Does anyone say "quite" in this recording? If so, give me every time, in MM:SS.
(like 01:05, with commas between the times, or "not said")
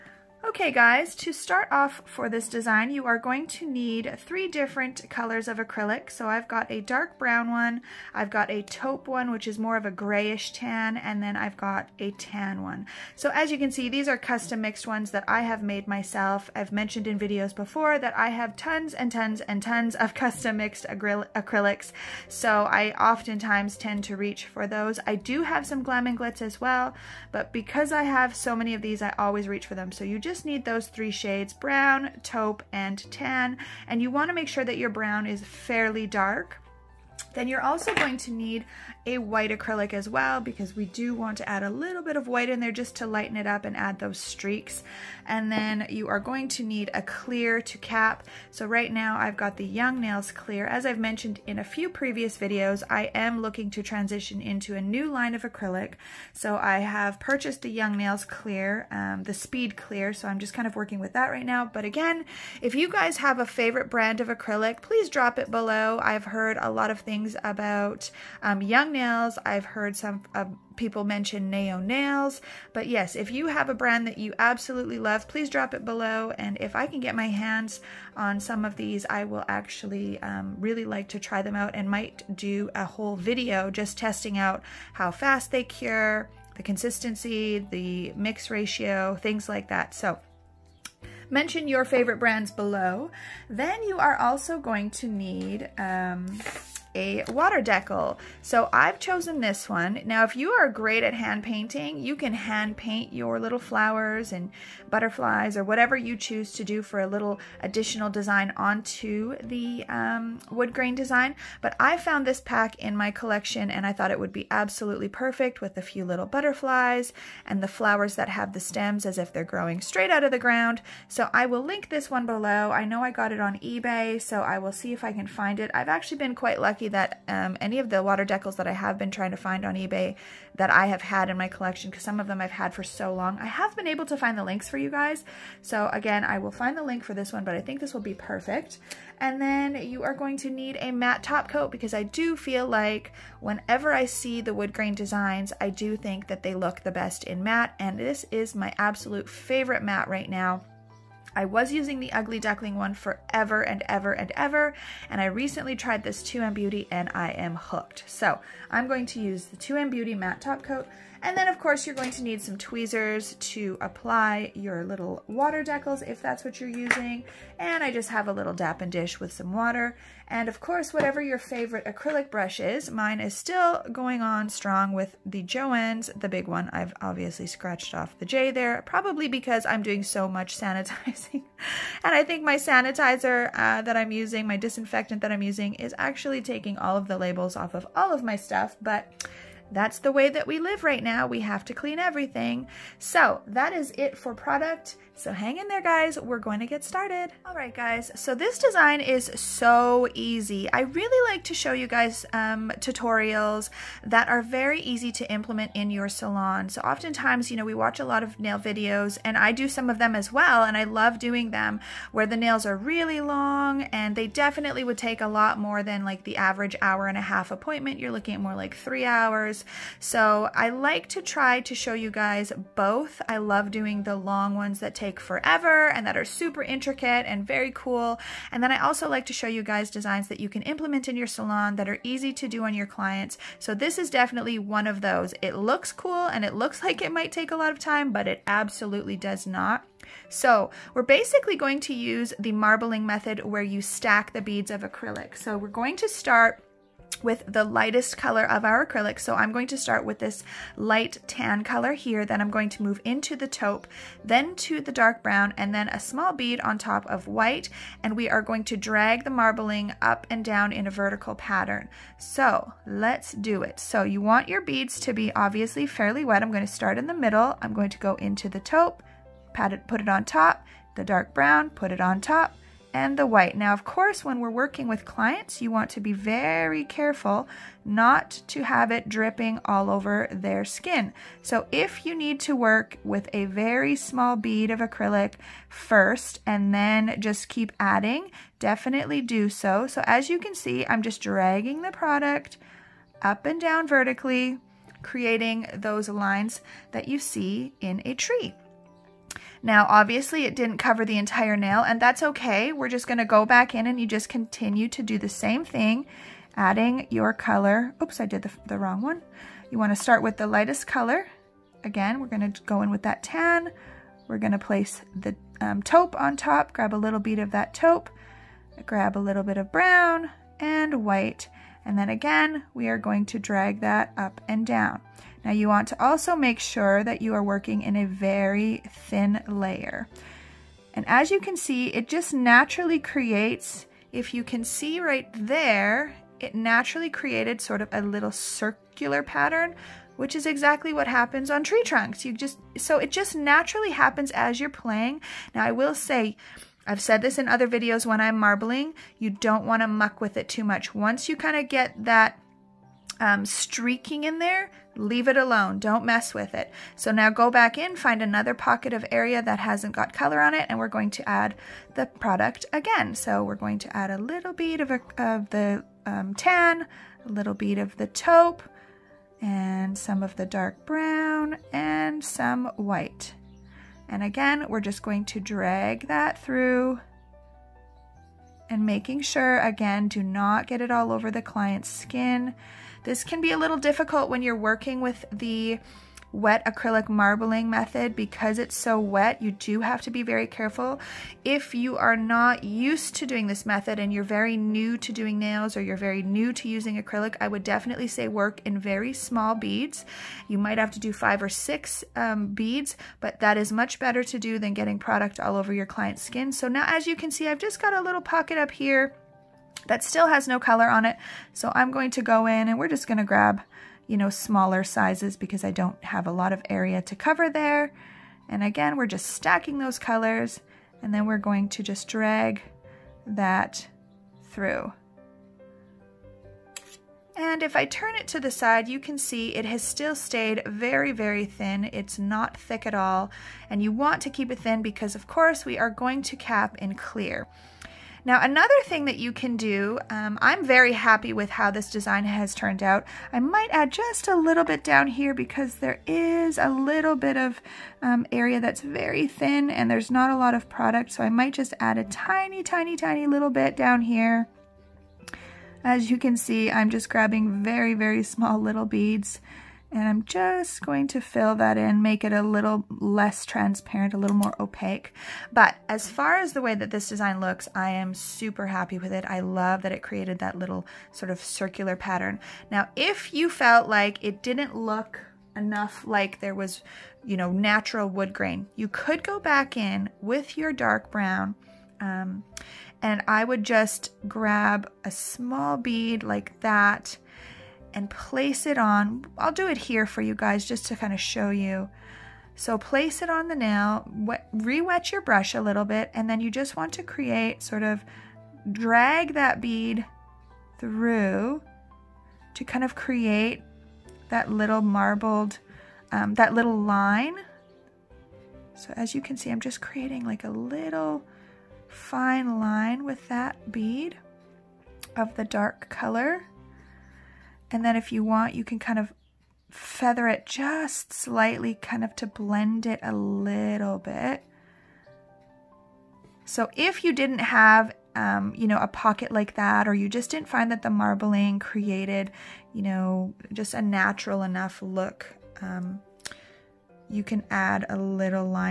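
02:06.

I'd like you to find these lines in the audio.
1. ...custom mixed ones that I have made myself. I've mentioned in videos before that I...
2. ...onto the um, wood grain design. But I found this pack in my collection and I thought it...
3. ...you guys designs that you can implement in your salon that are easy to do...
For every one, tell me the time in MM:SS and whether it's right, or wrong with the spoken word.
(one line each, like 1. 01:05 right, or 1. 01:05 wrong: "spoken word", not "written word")
1. 00:14 right
2. 01:48 right
3. 03:49 right.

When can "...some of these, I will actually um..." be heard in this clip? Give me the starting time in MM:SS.
01:18.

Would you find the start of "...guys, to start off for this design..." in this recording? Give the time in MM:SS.
00:00.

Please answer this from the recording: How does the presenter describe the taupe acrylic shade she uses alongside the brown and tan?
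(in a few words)
grayish tan.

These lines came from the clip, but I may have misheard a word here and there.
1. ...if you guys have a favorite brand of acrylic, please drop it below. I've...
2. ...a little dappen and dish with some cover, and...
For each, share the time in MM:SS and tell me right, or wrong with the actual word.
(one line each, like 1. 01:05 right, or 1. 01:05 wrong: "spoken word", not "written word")
1. 01:02 right
2. 02:48 wrong: "water", not "cover".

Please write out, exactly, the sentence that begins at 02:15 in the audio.
So again, I will find the link for this one, but I think this will be perfect.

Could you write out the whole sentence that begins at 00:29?
So you just need need those three shades, brown, taupe, and tan.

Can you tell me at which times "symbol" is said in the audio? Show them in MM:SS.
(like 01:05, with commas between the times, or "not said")
not said.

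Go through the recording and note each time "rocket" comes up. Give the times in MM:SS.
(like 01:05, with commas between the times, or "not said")
not said.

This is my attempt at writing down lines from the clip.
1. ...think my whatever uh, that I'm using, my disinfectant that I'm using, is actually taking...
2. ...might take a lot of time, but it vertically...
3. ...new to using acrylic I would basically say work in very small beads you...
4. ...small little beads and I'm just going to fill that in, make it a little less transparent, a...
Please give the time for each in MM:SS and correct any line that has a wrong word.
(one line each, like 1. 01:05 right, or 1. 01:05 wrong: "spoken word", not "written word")
1. 03:02 wrong: "sanitizer", not "whatever"
2. 03:57 wrong: "absolutely", not "vertically"
3. 06:36 wrong: "definitely", not "basically"
4. 07:38 right.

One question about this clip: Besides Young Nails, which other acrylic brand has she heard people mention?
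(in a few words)
Neo Nails.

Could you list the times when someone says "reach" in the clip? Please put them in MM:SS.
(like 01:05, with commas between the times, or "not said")
00:24, 00:29.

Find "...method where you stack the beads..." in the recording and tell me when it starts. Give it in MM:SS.
04:03.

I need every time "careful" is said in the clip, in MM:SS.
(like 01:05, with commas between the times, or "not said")
04:36, 06:30.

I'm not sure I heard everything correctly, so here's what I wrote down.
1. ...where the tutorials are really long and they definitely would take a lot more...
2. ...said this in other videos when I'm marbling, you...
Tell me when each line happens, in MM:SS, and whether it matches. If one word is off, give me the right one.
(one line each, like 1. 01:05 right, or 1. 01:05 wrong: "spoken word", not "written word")
1. 03:32 wrong: "nails", not "tutorials"
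2. 05:47 right.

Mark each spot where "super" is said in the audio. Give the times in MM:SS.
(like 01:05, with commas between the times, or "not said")
03:46, 07:48.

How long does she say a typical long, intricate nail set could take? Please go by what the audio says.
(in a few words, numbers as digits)
three hours.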